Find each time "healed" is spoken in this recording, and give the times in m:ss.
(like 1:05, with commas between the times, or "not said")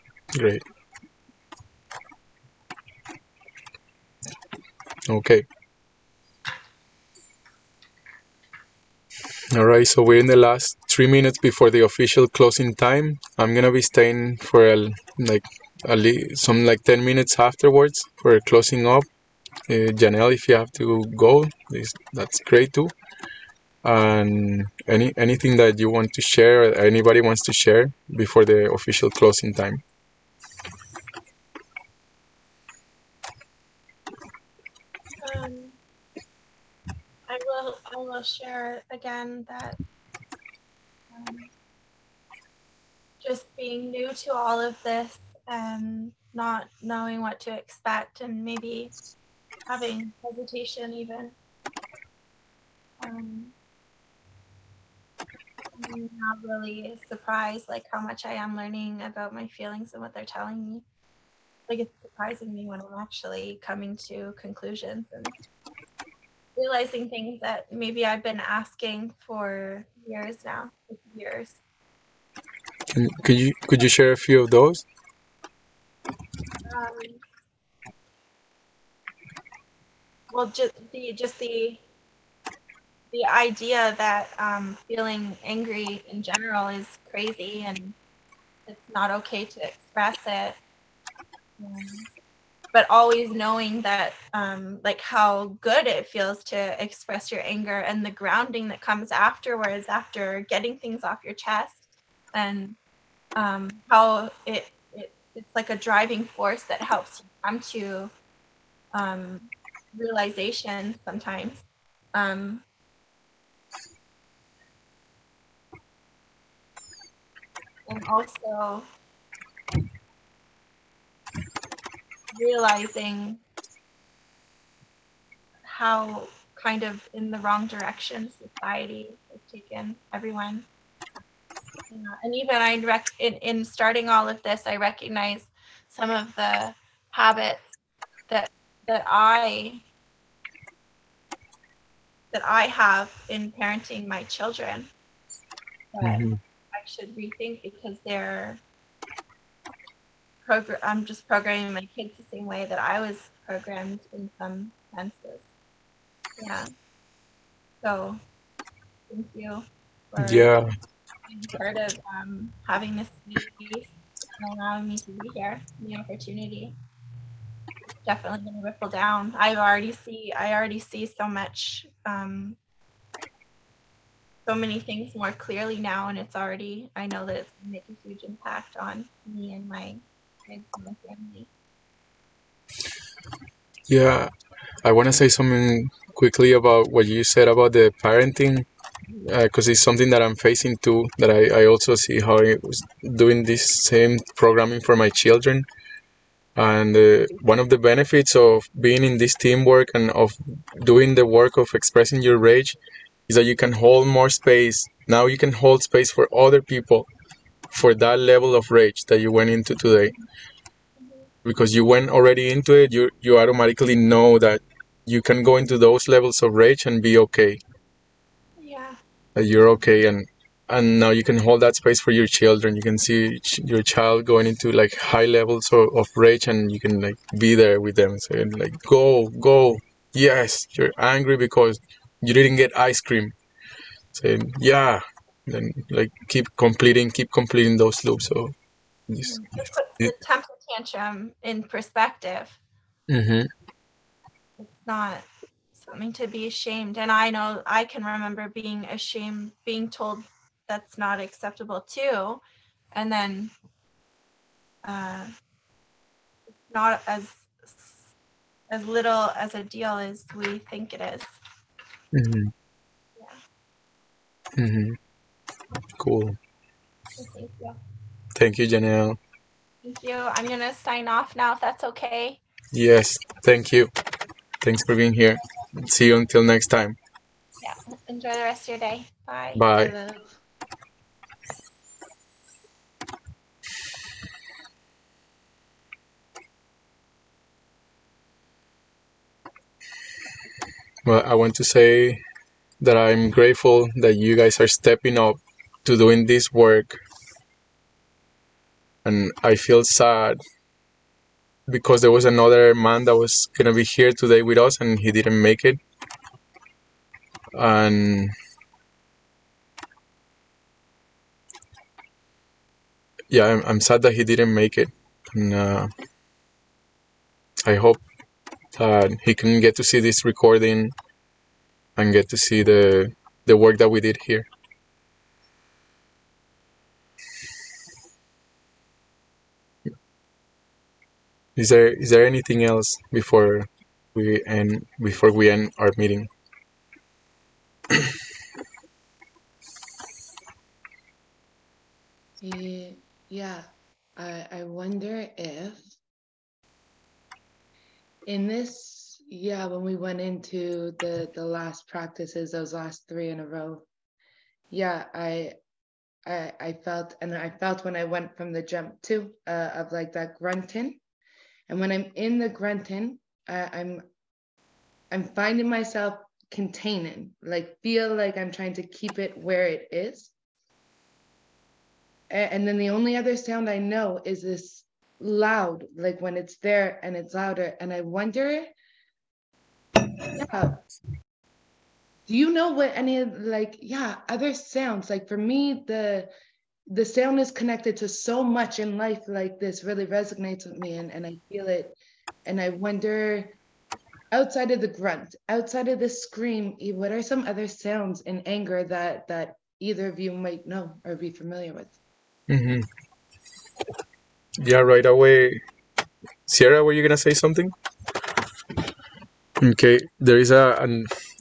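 not said.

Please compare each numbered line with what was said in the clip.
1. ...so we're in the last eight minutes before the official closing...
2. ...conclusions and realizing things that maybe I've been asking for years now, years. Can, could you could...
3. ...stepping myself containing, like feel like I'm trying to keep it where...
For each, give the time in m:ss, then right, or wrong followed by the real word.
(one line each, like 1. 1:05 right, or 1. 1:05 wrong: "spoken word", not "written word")
1. 0:09 wrong: "three", not "eight"
2. 1:04 right
3. 6:05 wrong: "finding", not "stepping".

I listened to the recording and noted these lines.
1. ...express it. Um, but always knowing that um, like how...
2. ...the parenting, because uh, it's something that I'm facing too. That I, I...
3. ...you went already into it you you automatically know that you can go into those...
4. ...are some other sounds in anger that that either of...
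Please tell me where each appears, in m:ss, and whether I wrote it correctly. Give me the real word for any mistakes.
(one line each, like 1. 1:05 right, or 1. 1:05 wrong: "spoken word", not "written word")
1. 1:29 right
2. 3:07 right
3. 3:31 right
4. 6:37 right.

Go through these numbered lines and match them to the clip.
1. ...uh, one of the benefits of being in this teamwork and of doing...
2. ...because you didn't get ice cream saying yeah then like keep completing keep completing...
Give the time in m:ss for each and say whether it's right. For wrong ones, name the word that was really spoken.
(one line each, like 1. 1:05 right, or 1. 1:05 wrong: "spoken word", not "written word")
1. 3:16 right
2. 3:51 right.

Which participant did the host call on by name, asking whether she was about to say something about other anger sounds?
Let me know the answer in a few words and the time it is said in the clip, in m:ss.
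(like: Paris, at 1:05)
Sierra, at 6:46.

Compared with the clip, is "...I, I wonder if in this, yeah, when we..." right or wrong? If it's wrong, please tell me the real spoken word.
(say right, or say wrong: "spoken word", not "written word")
right.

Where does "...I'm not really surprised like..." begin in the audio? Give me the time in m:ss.
0:55.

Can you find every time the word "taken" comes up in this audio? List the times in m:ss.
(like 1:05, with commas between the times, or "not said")
2:09.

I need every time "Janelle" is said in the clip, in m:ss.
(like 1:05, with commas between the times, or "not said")
0:19, 4:28.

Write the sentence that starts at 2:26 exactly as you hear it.
I should rethink because they're program I'm just programming my kids the same way that I was programmed in some senses.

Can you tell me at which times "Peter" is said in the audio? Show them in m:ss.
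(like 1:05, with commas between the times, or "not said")
not said.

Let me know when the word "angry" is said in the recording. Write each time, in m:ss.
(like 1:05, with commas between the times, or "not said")
1:25, 3:50.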